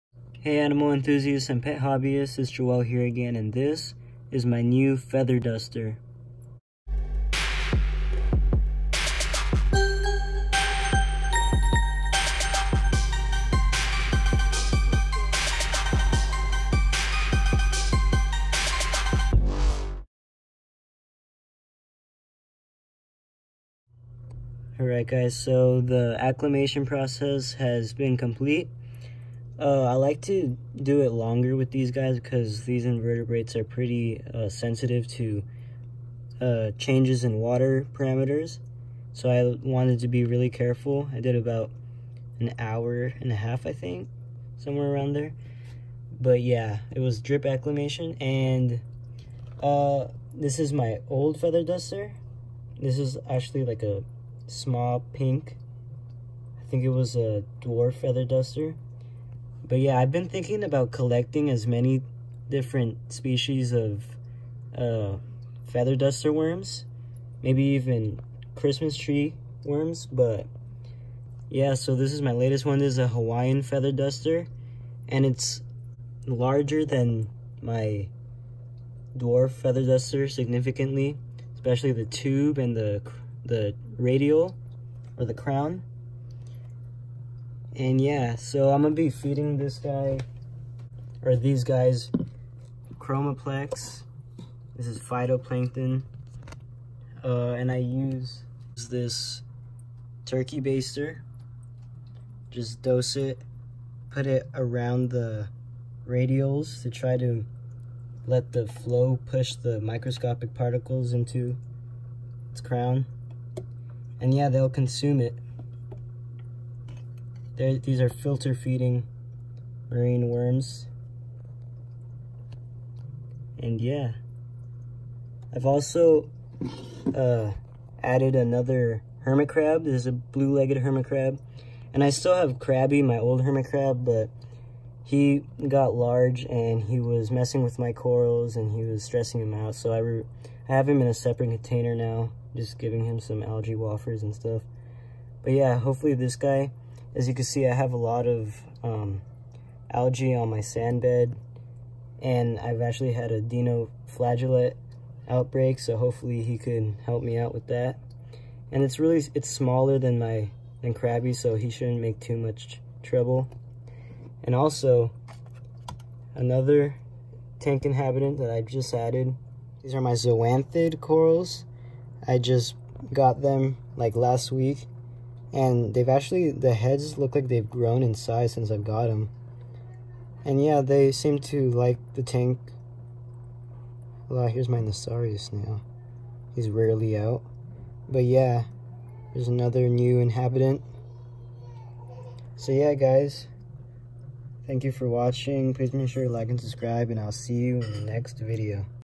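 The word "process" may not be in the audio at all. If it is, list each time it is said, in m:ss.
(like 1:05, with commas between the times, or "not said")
0:26.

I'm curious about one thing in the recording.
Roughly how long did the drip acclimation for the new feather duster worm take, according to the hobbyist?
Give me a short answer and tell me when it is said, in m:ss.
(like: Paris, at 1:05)
1.5 hours, at 0:42.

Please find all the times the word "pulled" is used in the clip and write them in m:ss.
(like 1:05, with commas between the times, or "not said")
not said.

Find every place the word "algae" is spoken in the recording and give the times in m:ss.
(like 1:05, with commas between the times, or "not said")
2:23, 2:29.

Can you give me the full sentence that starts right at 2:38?
And it's really, it's smaller than my, than Krabby, so he shouldn't make too much trouble.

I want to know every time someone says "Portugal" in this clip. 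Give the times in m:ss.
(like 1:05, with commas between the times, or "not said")
not said.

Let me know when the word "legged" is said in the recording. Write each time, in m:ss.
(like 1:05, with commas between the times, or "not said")
2:10.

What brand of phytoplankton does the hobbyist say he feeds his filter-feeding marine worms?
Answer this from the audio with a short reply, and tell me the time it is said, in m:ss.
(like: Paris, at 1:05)
Chromaplex, at 1:32.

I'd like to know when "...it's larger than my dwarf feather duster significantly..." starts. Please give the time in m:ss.
1:15.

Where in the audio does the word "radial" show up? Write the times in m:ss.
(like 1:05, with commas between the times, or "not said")
1:23, 1:46.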